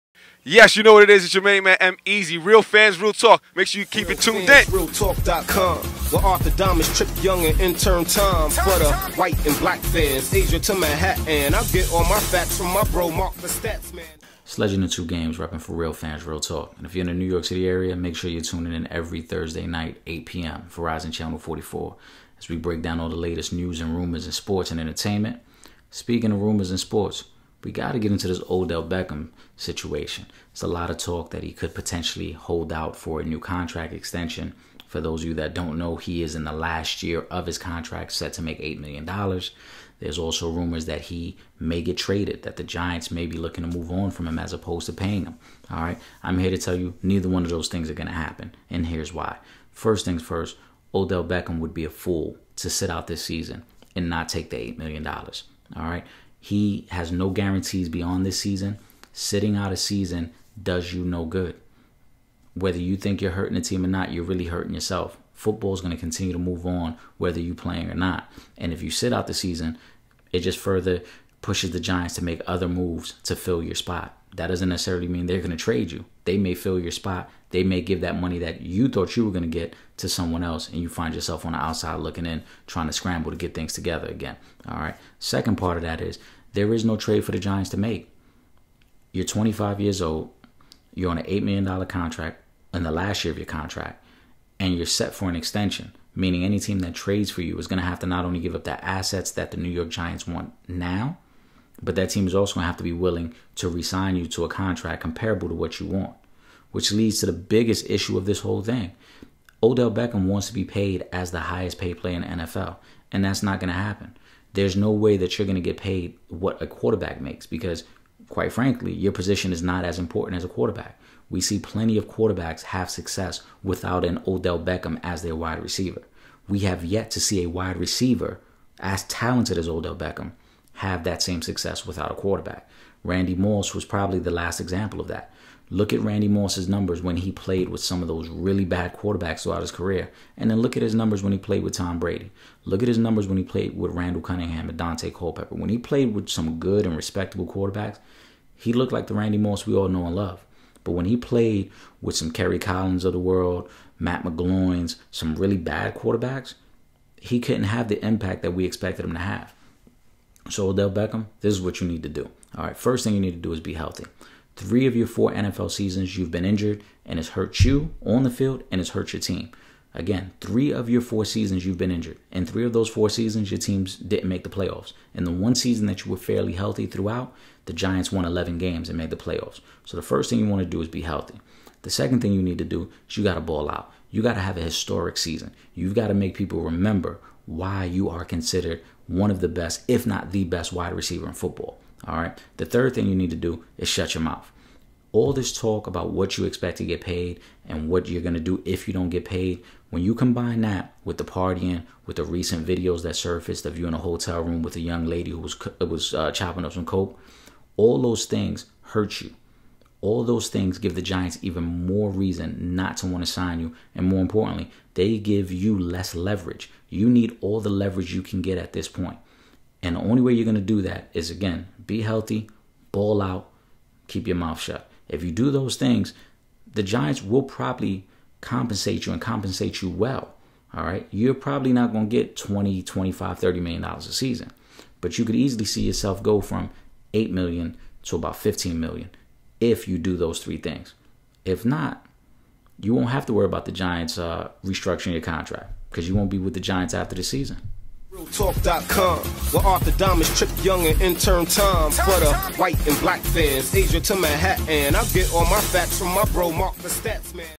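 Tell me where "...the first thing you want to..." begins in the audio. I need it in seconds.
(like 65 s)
179 s.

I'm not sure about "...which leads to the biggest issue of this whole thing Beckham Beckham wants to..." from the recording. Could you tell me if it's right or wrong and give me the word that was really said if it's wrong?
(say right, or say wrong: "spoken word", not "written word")
wrong: "Odell", not "Beckham".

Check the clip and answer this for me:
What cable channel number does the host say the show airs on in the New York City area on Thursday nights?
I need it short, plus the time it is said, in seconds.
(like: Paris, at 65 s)
44, at 20 s.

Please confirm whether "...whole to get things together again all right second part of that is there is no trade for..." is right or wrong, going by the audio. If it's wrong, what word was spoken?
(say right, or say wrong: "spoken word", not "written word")
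wrong: "scramble", not "whole".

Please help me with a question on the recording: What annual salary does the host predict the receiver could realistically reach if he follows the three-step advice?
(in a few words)
$15 million.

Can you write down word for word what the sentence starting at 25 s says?
Speaking of rumors and sports, we got to get into this Odell Beckham situation.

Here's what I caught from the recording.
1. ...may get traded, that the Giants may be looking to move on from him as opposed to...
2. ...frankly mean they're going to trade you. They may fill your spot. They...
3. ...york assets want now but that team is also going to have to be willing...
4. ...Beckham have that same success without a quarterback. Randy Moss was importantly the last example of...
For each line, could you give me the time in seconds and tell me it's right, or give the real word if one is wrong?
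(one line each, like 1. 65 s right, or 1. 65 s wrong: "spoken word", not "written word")
1. 41 s right
2. 74 s wrong: "necessarily", not "frankly"
3. 99 s wrong: "giants", not "assets"
4. 129 s wrong: "probably", not "importantly".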